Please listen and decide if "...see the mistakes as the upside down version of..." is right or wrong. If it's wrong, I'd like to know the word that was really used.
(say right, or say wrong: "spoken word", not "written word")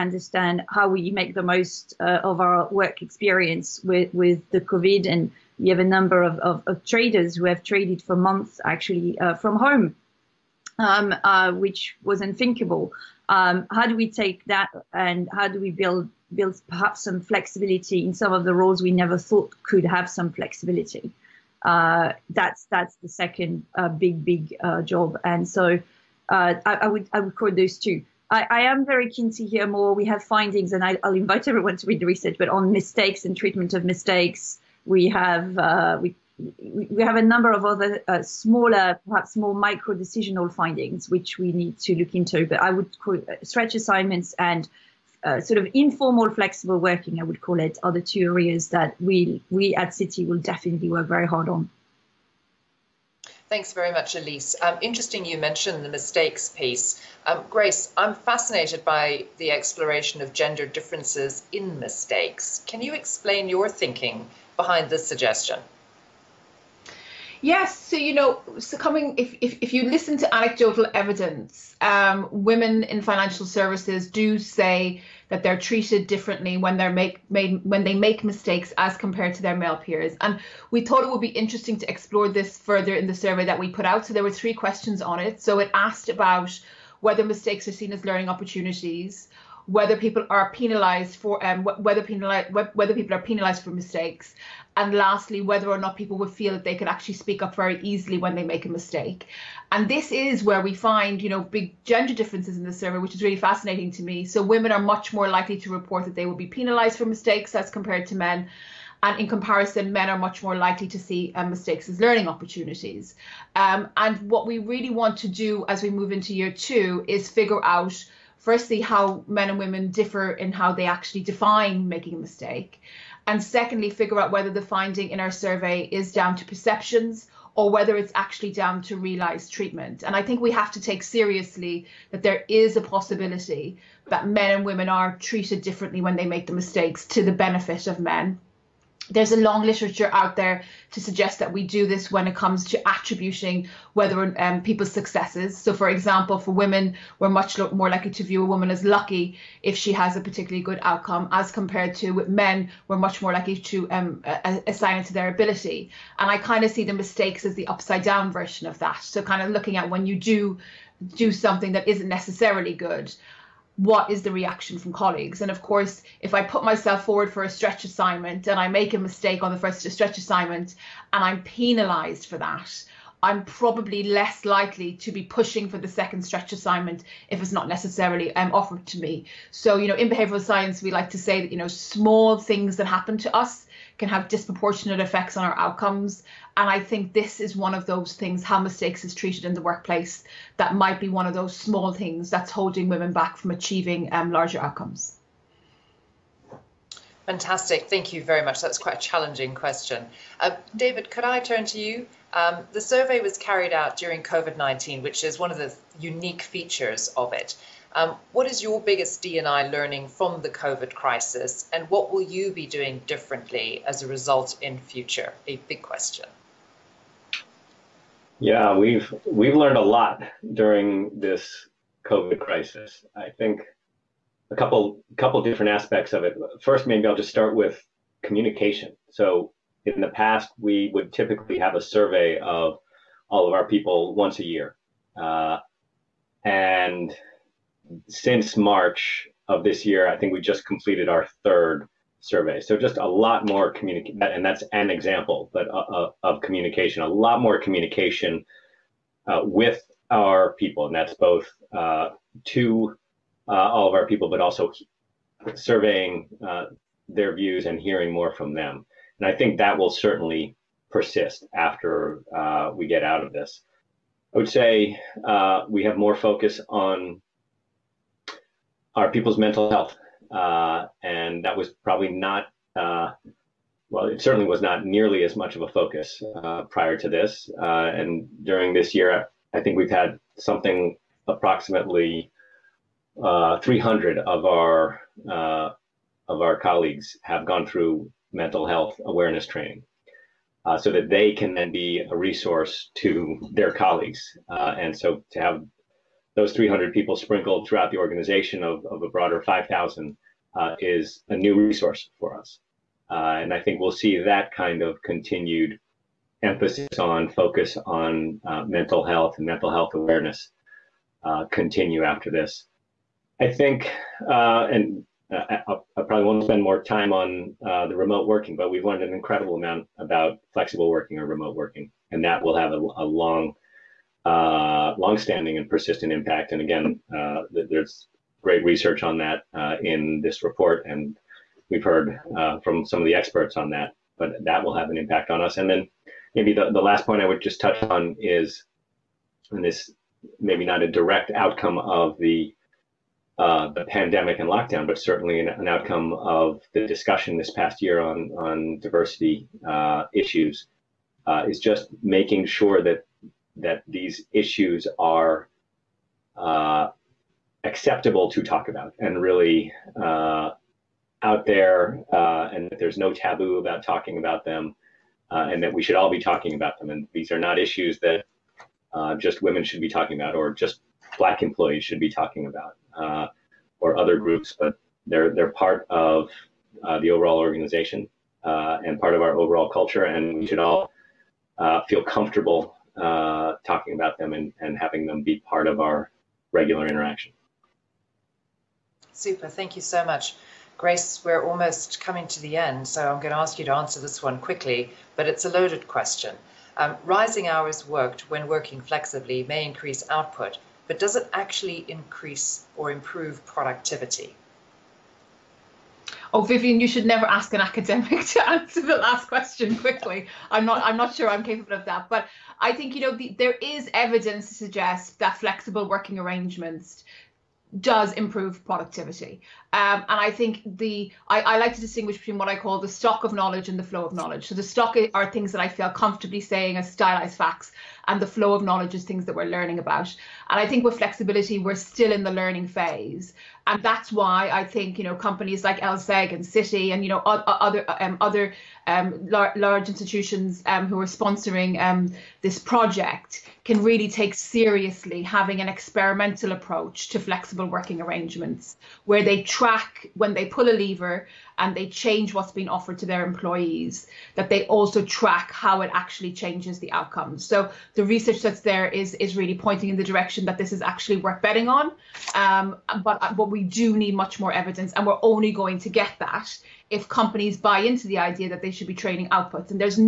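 right.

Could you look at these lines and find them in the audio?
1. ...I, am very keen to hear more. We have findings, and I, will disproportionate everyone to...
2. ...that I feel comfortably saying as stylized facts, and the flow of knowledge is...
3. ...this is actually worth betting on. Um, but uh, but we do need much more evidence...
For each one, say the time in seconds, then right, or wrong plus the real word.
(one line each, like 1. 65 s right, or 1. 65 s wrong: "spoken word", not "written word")
1. 28 s wrong: "invite", not "disproportionate"
2. 425 s right
3. 460 s right.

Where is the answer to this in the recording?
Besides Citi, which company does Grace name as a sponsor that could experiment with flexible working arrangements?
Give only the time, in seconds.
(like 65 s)
435 s.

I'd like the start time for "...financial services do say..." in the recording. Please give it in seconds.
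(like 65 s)
73 s.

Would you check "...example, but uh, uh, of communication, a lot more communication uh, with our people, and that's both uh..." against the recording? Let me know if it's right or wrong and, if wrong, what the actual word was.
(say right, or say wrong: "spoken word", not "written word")
right.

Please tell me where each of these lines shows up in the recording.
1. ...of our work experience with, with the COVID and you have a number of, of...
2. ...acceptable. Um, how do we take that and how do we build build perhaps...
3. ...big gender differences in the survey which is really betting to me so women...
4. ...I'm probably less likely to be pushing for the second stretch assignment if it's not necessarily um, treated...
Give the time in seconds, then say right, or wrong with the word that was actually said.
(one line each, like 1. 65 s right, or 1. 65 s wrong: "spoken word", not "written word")
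1. 1 s right
2. 12 s wrong: "unthinkable", not "acceptable"
3. 101 s wrong: "fascinating", not "betting"
4. 173 s wrong: "offered", not "treated".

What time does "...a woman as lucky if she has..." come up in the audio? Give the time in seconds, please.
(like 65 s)
148 s.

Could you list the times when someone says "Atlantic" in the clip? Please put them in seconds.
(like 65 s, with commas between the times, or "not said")
not said.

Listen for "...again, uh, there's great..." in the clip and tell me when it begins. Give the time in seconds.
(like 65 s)
326 s.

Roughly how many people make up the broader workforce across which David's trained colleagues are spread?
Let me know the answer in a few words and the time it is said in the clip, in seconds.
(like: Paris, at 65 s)
5,000, at 299 s.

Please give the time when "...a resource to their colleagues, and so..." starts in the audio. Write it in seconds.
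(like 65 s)
292 s.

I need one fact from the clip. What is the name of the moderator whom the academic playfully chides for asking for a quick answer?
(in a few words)
Vivienne.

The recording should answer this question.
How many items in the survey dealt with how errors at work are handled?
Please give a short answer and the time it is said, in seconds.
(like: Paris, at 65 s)
3, at 84 s.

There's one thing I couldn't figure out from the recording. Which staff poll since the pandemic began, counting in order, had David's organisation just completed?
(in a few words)
third.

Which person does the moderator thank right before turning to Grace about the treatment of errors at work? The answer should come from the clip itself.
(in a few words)
Elise.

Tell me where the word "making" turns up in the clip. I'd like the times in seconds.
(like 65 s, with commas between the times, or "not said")
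121 s, 352 s.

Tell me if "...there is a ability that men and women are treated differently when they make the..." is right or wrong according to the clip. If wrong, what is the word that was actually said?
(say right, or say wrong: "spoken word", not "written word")
wrong: "possibility", not "ability".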